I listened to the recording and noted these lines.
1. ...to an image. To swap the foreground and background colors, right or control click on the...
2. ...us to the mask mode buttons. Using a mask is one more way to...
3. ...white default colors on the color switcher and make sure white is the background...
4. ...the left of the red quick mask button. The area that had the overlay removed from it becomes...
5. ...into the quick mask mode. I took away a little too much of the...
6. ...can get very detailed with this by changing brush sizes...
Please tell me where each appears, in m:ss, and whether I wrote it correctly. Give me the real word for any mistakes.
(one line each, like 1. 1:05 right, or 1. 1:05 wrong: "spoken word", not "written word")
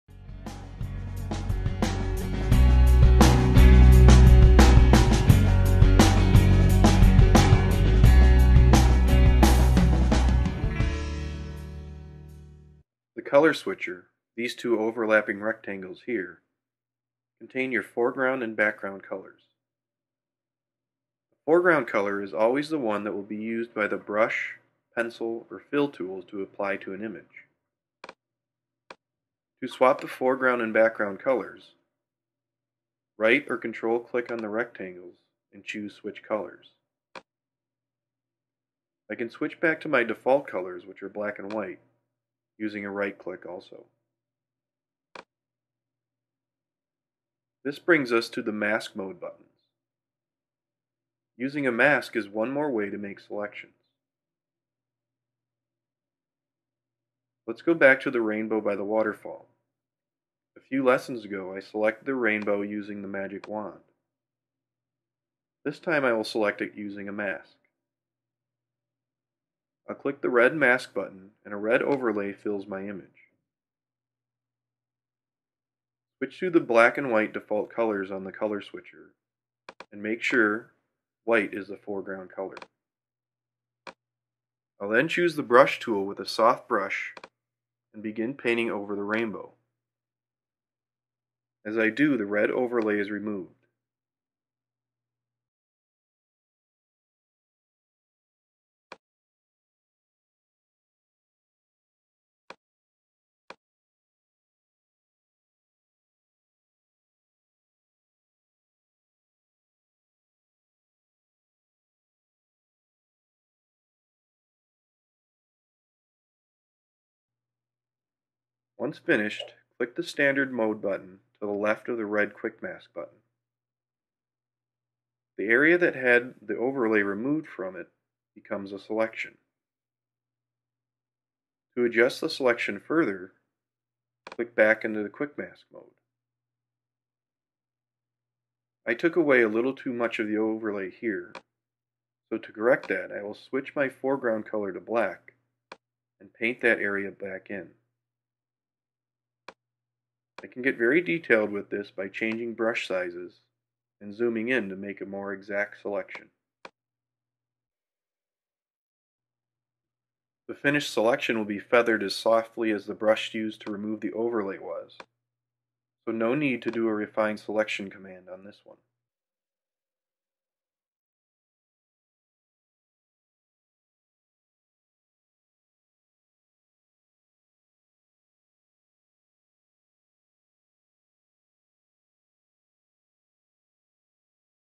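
1. 0:26 right
2. 0:48 right
3. 1:17 wrong: "foreground", not "background"
4. 2:01 right
5. 2:14 right
6. 2:30 right.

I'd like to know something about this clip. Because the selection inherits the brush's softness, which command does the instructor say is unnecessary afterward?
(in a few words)
refine selection.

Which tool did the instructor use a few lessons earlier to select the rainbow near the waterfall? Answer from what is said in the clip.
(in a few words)
magic wand.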